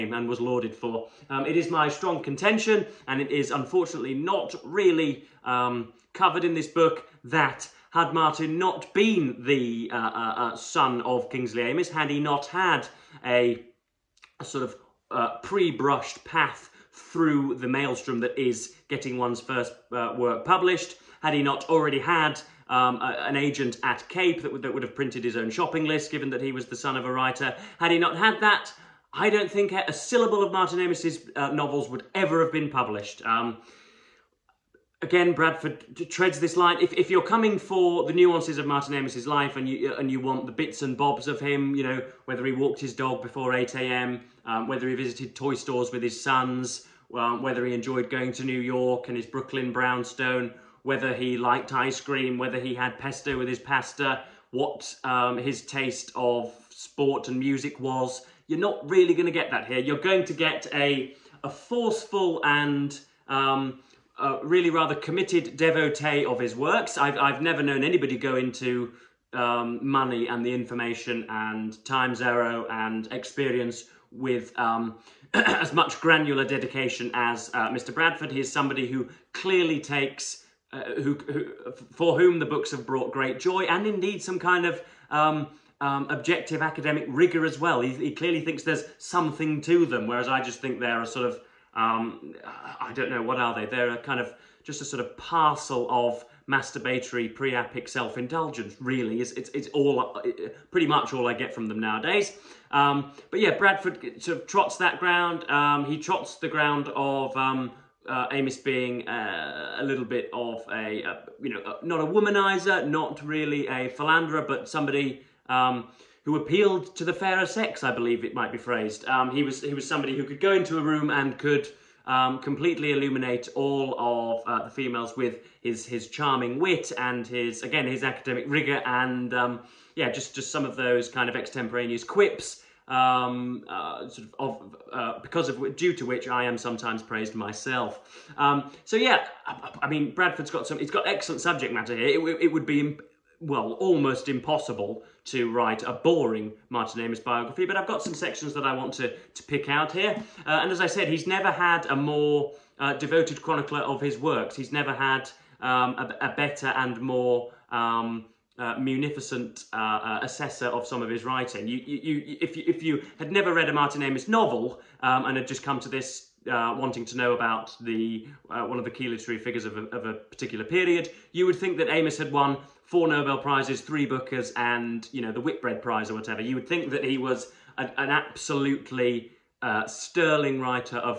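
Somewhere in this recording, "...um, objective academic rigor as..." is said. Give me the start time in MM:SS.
01:25.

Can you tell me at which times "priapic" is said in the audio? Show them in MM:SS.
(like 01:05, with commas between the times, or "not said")
01:37.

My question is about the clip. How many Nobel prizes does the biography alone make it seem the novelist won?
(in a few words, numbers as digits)
4.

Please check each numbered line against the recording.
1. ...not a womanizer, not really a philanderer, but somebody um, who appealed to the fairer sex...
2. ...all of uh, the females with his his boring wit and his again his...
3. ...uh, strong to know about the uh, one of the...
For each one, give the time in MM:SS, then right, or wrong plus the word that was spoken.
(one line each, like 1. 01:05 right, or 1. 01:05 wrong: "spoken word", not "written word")
1. 01:51 right
2. 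02:03 wrong: "charming", not "boring"
3. 02:46 wrong: "wanting", not "strong".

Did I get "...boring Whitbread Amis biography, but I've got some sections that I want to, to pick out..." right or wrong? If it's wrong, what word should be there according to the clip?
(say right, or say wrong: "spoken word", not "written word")
wrong: "Martin", not "Whitbread".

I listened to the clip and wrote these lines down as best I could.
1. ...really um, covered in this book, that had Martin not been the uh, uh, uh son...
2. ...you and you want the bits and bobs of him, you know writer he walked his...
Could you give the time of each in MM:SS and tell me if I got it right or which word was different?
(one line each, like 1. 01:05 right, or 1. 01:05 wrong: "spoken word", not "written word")
1. 00:04 right
2. 00:39 wrong: "whether", not "writer".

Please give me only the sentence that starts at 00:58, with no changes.
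You're not really going to get that here.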